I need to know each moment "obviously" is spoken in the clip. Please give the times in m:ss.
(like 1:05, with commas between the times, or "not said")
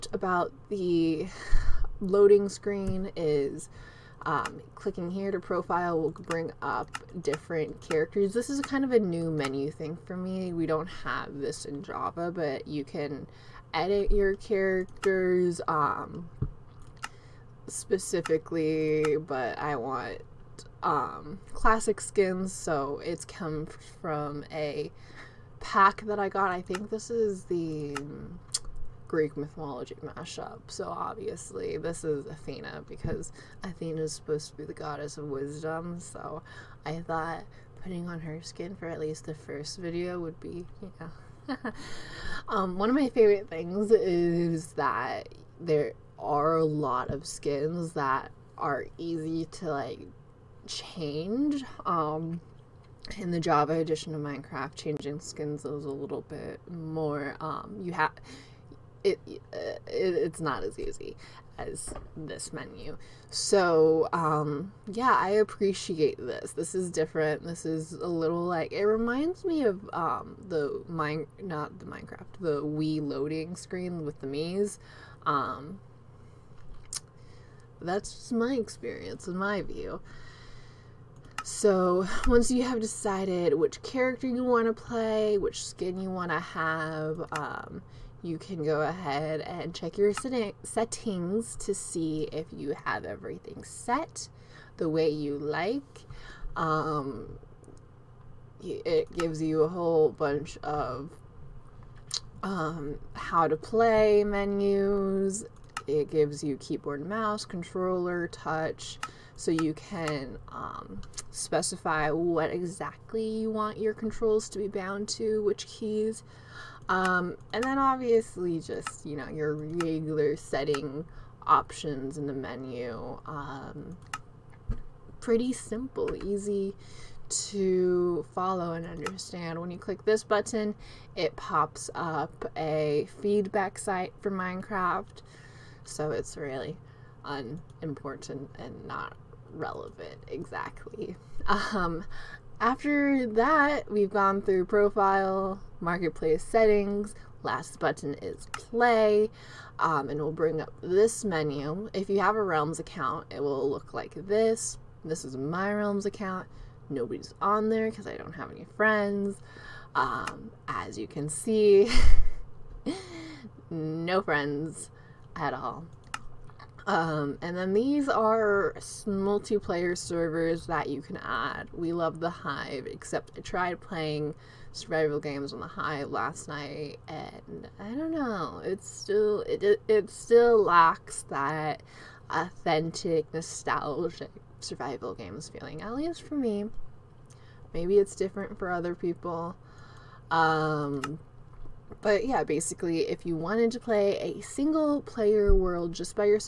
0:30, 1:57.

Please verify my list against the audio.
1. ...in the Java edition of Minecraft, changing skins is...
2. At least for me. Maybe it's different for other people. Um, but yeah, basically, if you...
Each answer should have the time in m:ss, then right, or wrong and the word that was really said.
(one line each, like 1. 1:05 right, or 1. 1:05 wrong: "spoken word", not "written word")
1. 0:53 right
2. 3:05 right.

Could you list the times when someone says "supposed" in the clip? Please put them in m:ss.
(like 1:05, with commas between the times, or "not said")
0:34.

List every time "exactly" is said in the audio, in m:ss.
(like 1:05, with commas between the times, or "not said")
1:52, 2:20.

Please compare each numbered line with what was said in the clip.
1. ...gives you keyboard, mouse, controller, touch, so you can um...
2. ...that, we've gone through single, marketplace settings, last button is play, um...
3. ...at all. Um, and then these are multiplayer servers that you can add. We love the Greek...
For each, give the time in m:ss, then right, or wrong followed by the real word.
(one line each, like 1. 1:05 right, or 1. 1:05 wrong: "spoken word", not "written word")
1. 1:46 right
2. 2:23 wrong: "profile", not "single"
3. 2:45 wrong: "Hive", not "Greek".